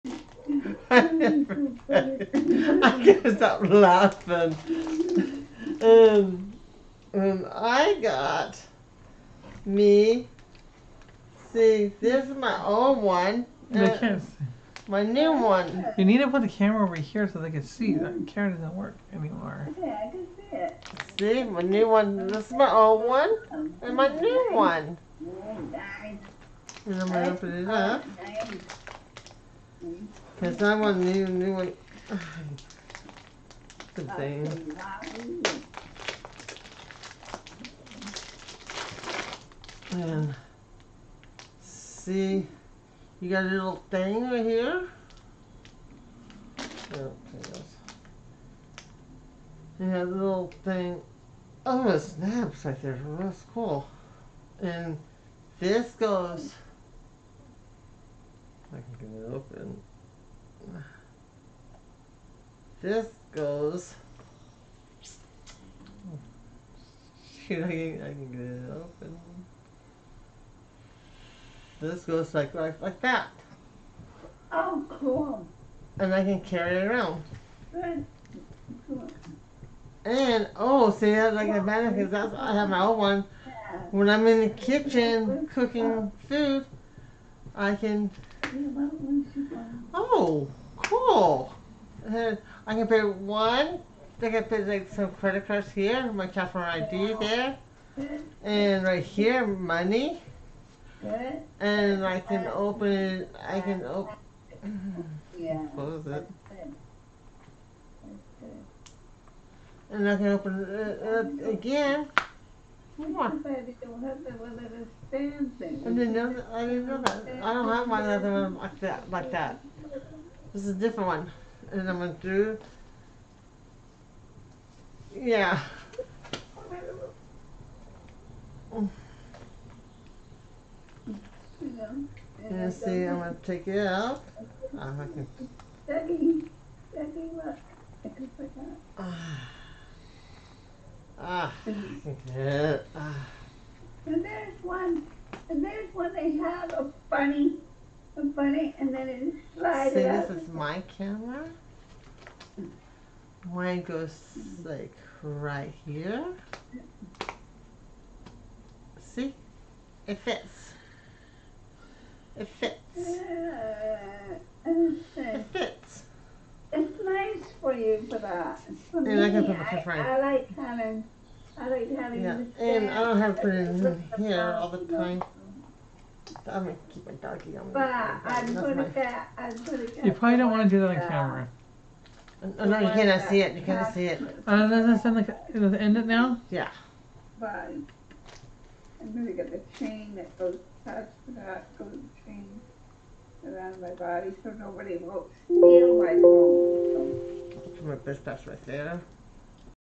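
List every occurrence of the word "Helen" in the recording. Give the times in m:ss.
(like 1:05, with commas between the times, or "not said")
2:50.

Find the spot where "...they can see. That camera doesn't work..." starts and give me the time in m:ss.
0:17.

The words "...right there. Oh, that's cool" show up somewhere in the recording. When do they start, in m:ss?
0:52.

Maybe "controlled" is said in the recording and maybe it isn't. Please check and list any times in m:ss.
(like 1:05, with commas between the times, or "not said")
not said.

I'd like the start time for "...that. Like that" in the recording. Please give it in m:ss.
1:58.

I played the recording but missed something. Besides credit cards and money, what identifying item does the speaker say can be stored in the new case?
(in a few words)
customer ID.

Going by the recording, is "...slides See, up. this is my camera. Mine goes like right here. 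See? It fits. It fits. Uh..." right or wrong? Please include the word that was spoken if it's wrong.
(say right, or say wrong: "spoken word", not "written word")
right.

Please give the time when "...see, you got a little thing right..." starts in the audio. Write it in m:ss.
0:41.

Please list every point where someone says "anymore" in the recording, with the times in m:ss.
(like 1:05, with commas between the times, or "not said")
0:19.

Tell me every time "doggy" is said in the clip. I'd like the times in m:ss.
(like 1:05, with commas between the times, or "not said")
2:57.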